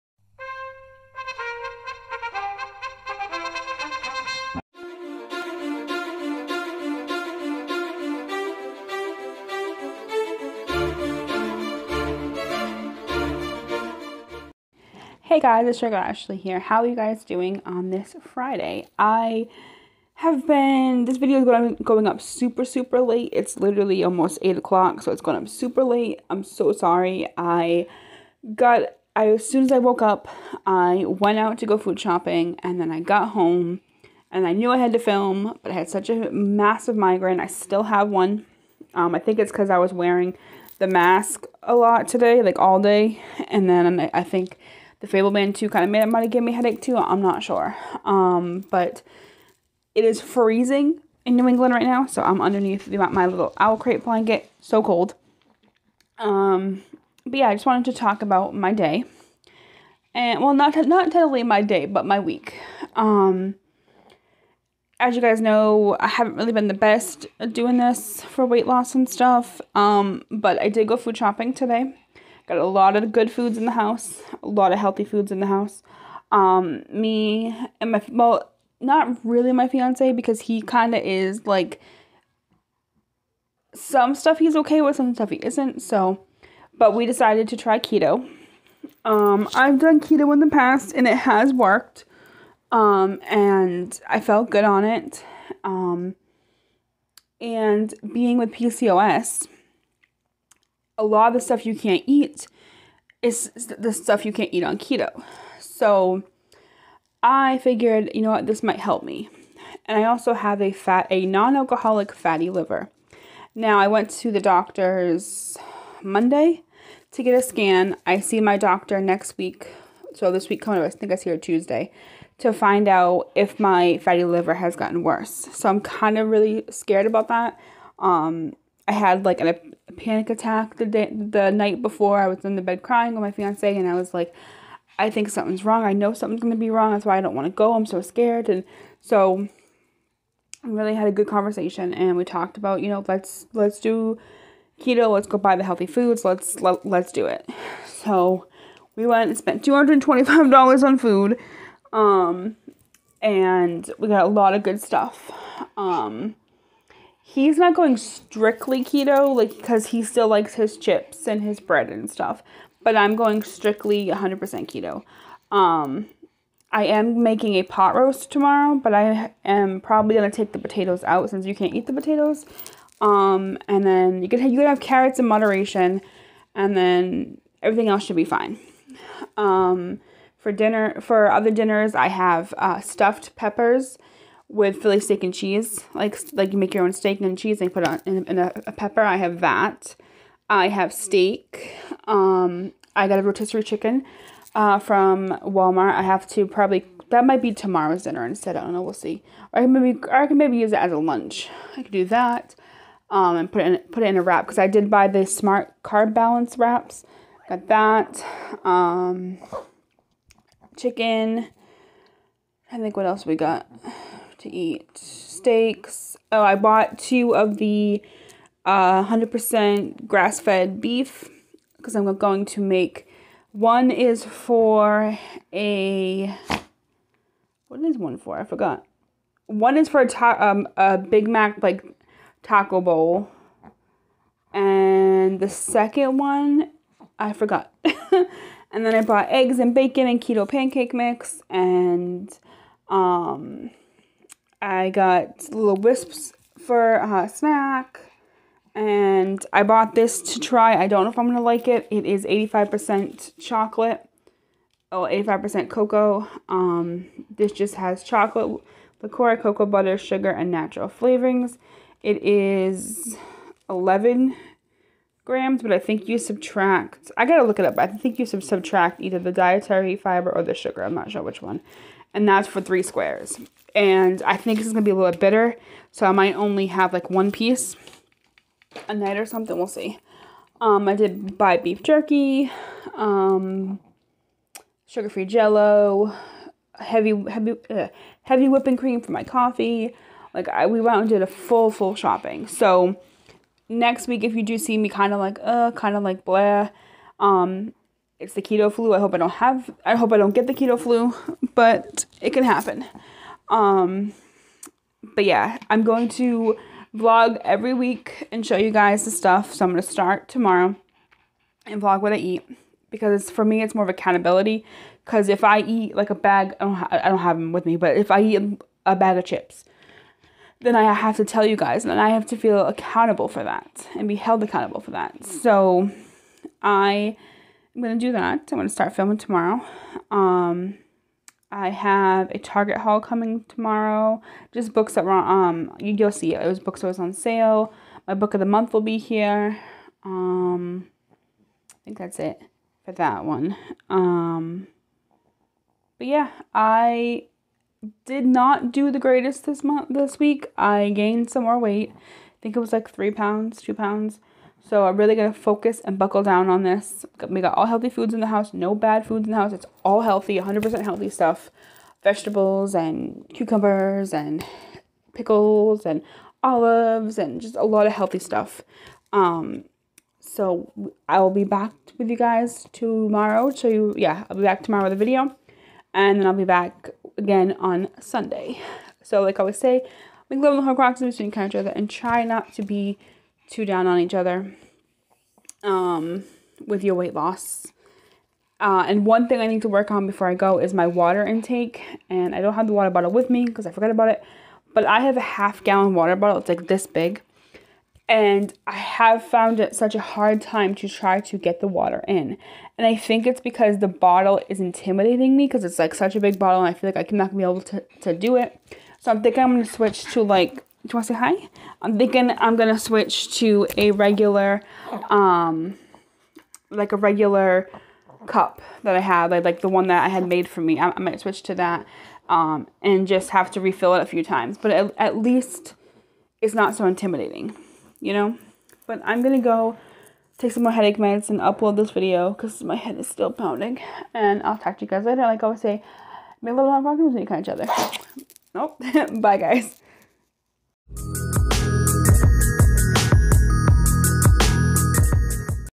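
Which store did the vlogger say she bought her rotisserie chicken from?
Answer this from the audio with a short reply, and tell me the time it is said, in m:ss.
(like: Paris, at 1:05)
Walmart, at 3:15.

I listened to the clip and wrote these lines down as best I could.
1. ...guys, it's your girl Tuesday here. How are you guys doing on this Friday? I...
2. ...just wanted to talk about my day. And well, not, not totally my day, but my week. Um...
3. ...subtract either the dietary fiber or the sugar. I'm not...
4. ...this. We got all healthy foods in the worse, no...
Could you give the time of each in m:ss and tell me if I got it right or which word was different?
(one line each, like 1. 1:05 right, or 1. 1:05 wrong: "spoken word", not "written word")
1. 0:15 wrong: "Ashley", not "Tuesday"
2. 0:57 right
3. 4:28 right
4. 5:56 wrong: "house", not "worse".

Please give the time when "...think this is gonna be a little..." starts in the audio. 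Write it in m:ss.
4:34.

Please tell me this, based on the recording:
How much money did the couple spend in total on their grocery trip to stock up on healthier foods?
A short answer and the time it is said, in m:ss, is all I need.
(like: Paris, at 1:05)
$225, at 2:29.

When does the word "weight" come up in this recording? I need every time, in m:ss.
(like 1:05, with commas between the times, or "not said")
1:08, 5:51, 6:26.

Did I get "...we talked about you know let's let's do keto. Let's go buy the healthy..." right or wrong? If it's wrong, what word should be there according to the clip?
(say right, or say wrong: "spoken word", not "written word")
right.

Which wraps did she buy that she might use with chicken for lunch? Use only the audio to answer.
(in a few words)
Smart carb balance wraps.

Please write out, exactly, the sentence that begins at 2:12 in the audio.
I was in the bed crying with my fiance, and I was like, I think something's wrong.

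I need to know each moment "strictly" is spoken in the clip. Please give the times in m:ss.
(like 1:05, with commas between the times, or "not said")
2:37, 2:43.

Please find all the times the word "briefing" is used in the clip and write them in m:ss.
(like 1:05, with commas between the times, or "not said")
not said.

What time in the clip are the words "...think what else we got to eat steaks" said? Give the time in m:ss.
3:32.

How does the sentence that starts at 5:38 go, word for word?
My book of the month will be here.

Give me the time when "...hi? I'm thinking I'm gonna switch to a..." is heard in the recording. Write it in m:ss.
6:51.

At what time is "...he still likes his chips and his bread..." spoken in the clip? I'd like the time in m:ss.
2:39.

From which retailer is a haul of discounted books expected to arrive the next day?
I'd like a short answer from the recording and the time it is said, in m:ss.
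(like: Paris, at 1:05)
Target, at 5:32.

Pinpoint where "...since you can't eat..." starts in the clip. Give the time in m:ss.
2:51.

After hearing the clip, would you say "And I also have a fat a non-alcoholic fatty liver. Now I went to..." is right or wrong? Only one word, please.
right.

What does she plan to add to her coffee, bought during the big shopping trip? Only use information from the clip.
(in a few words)
Heavy whipping cream.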